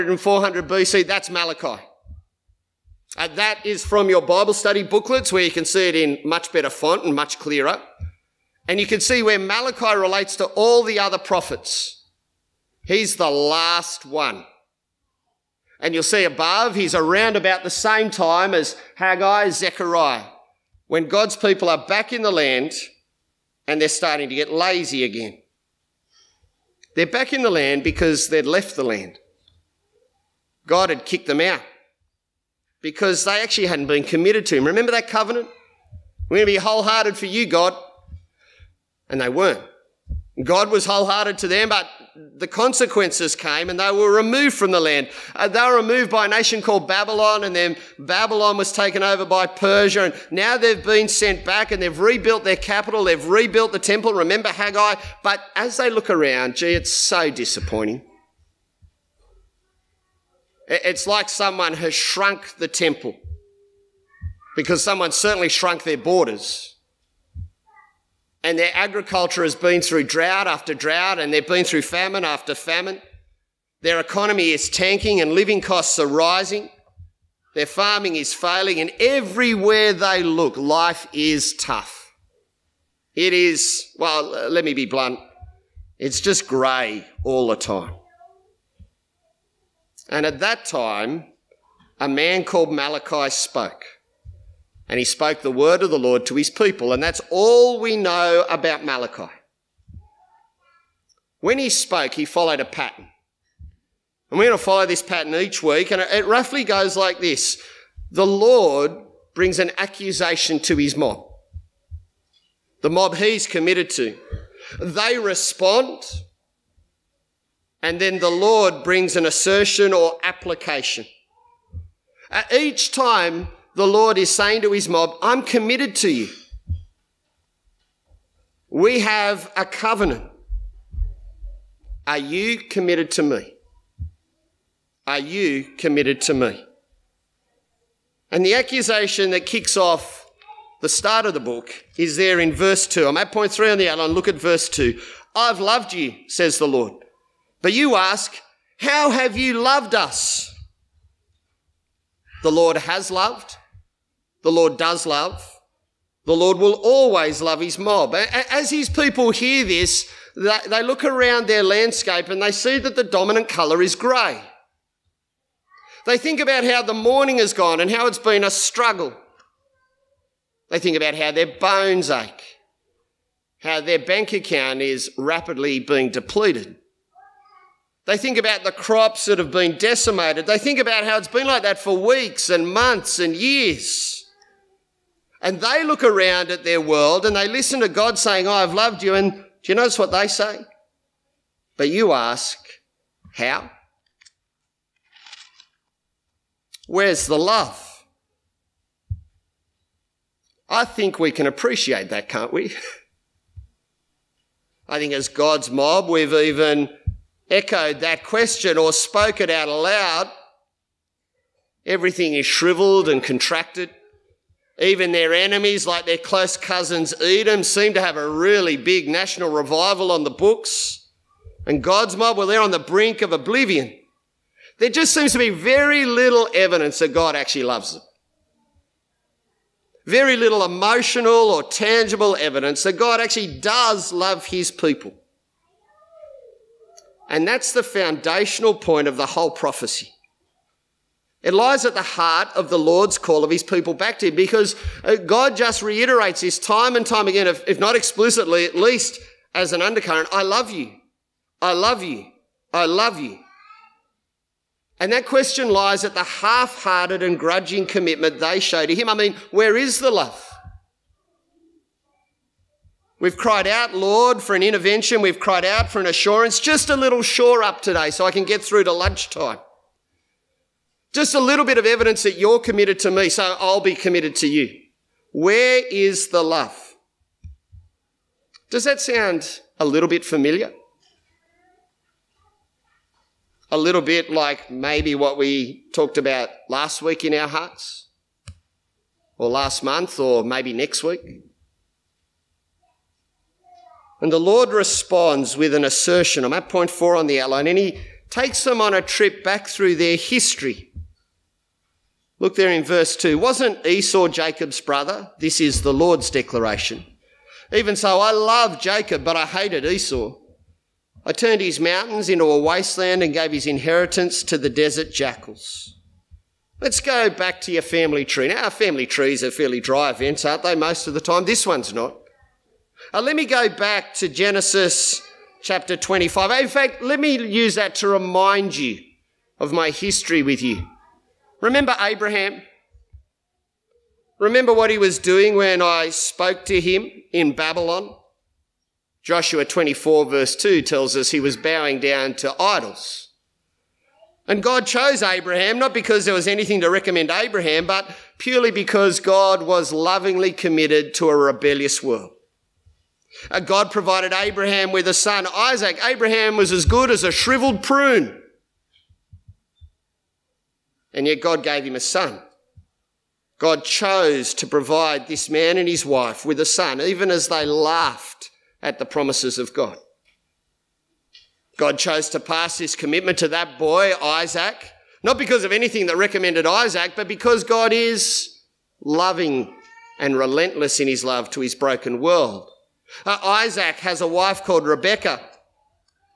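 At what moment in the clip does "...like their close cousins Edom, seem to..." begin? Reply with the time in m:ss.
3:35.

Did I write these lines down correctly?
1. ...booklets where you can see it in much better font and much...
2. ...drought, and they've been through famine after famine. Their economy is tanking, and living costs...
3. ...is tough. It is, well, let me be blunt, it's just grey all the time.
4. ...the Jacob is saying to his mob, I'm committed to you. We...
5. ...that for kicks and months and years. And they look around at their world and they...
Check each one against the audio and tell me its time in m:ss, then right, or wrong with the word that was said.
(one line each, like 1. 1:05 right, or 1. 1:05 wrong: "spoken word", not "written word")
1. 0:04 right
2. 1:10 right
3. 1:21 right
4. 2:03 wrong: "Lord", not "Jacob"
5. 3:01 wrong: "weeks", not "kicks".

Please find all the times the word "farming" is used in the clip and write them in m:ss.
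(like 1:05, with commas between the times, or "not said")
1:17.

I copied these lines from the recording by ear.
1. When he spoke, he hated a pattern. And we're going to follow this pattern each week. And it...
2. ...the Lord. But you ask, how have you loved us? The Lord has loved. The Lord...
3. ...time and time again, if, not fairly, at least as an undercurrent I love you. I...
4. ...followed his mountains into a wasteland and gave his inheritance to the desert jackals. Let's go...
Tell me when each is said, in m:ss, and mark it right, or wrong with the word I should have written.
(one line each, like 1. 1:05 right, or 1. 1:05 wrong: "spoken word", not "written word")
1. 1:41 wrong: "followed", not "hated"
2. 2:26 right
3. 4:06 wrong: "explicitly", not "fairly"
4. 5:11 wrong: "turned", not "followed".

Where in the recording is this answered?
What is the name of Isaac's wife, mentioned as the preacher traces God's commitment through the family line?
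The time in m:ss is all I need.
6:24.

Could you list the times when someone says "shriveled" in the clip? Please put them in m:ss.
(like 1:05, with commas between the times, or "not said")
3:32, 5:57.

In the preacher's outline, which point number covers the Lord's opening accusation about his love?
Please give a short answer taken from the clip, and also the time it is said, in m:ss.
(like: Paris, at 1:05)
3, at 2:23.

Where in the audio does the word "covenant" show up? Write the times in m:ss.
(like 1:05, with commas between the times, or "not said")
0:35, 2:09.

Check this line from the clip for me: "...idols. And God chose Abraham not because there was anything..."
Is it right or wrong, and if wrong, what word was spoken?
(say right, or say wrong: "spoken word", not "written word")
right.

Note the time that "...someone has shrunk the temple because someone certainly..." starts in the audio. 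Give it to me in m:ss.
1:01.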